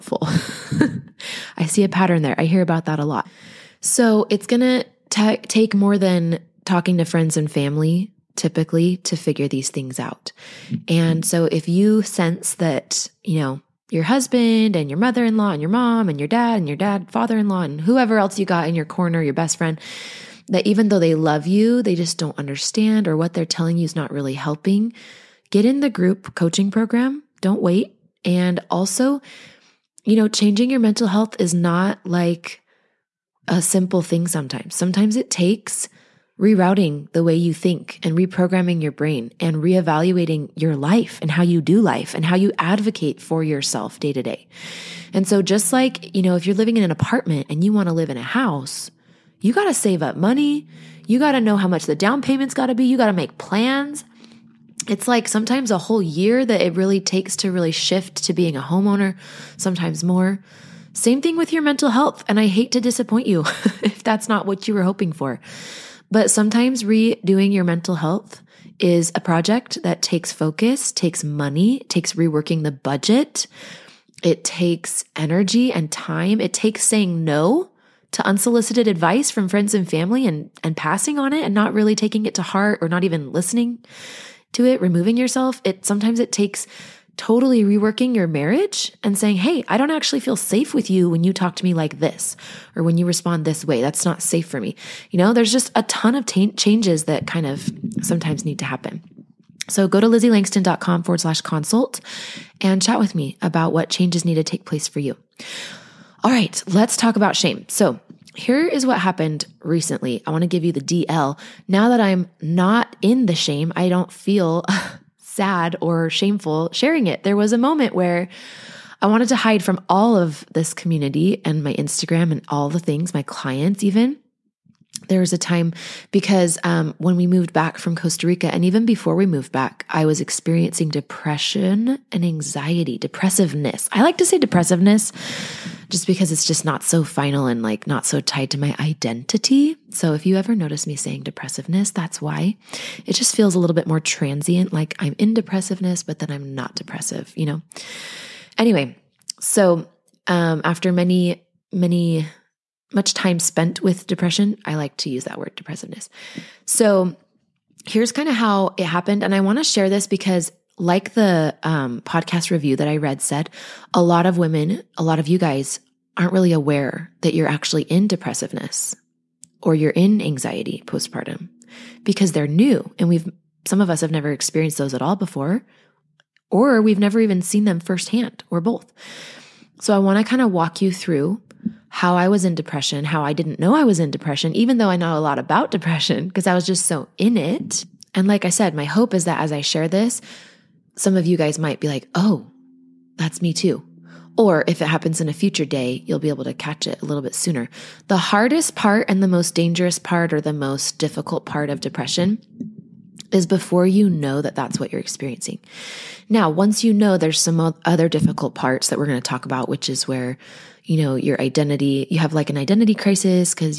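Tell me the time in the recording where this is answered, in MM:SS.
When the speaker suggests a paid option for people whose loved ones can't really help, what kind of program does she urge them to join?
00:25.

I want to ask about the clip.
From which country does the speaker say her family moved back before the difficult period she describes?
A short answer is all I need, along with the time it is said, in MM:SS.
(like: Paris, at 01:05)
Costa Rica, at 02:07.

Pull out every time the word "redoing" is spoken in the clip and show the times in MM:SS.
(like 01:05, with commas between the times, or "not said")
01:06.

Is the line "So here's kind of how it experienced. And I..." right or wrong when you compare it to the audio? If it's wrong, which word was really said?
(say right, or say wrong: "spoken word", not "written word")
wrong: "happened", not "experienced".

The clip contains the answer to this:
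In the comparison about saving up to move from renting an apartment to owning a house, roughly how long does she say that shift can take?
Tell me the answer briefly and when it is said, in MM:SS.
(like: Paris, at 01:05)
A whole year, at 00:55.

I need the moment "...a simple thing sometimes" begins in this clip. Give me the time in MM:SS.
00:33.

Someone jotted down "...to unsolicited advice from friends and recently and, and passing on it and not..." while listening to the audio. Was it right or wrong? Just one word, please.
wrong.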